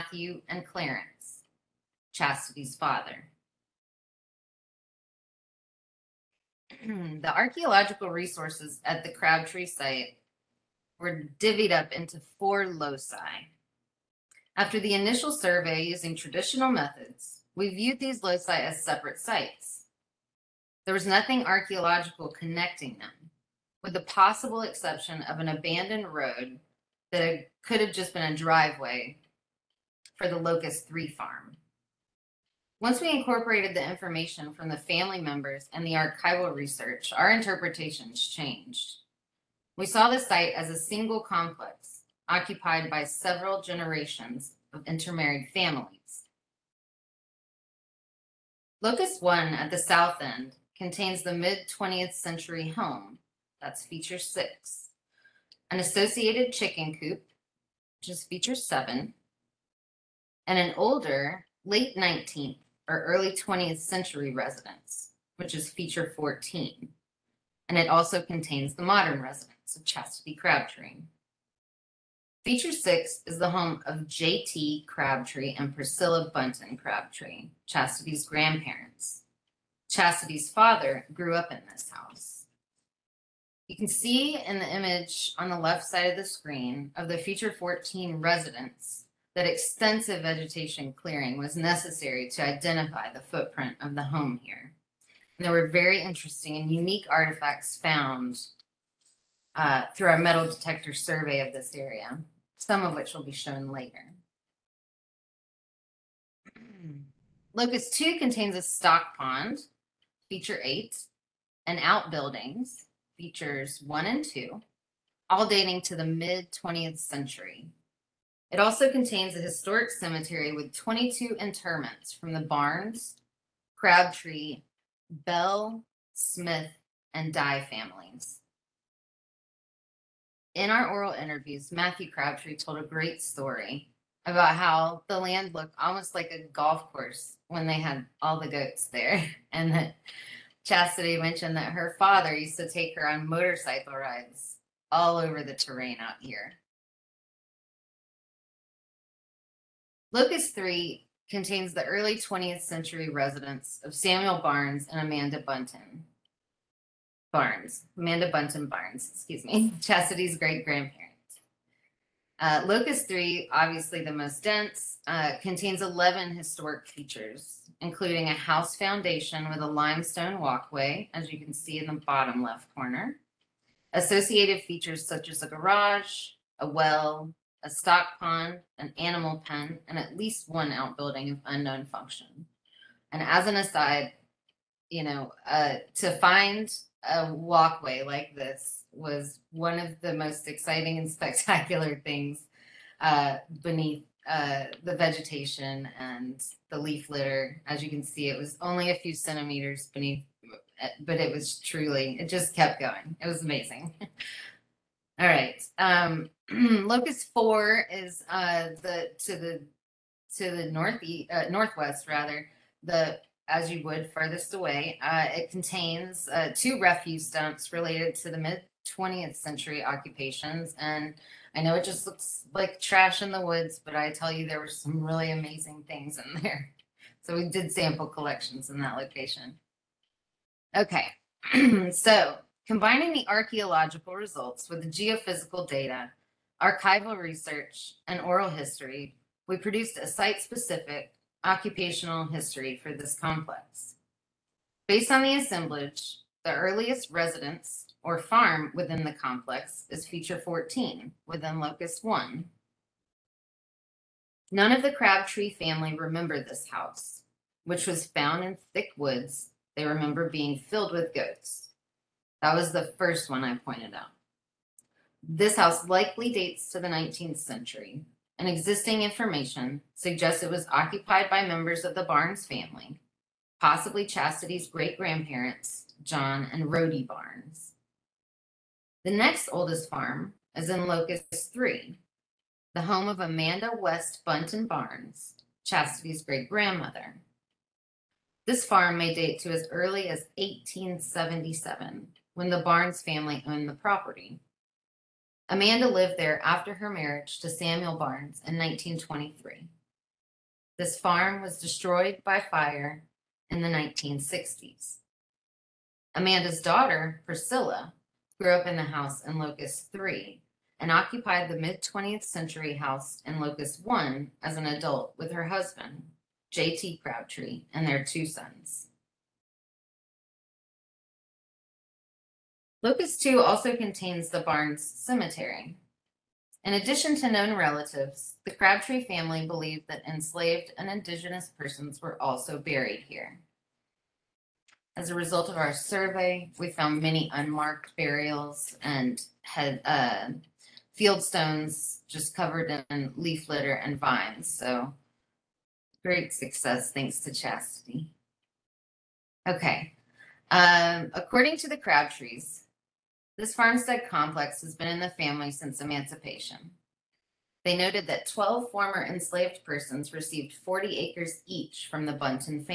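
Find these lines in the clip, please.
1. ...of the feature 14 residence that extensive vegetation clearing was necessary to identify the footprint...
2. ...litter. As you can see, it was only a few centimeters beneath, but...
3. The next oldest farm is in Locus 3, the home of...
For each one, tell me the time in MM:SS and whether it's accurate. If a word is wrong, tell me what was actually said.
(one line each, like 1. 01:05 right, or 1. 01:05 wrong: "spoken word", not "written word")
1. 01:26 right
2. 03:17 right
3. 04:39 right.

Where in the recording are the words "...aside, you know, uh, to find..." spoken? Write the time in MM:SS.
03:03.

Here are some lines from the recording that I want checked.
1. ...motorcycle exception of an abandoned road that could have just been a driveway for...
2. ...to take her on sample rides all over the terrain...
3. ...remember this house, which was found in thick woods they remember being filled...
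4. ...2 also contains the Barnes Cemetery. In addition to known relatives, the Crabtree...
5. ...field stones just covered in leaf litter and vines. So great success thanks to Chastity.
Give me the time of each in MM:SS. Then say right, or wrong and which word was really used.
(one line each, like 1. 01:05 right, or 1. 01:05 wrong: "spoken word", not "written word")
1. 00:24 wrong: "possible", not "motorcycle"
2. 02:22 wrong: "motorcycle", not "sample"
3. 04:15 right
4. 05:23 right
5. 05:40 right.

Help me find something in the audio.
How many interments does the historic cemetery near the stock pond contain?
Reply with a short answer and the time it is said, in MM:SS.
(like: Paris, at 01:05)
22, at 02:00.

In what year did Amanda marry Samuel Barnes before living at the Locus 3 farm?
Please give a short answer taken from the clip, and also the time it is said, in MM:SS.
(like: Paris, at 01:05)
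1923, at 04:58.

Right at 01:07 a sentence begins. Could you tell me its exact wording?
And it also contains the modern residence of Chastity Crabtree.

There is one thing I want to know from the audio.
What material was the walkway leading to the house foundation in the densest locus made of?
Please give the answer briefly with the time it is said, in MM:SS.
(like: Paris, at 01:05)
Limestone, at 02:49.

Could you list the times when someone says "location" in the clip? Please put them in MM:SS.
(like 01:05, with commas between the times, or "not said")
03:48.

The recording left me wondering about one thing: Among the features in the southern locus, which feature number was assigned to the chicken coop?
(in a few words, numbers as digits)
7.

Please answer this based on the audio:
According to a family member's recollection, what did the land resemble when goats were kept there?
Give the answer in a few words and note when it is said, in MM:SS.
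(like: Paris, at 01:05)
A golf course, at 02:16.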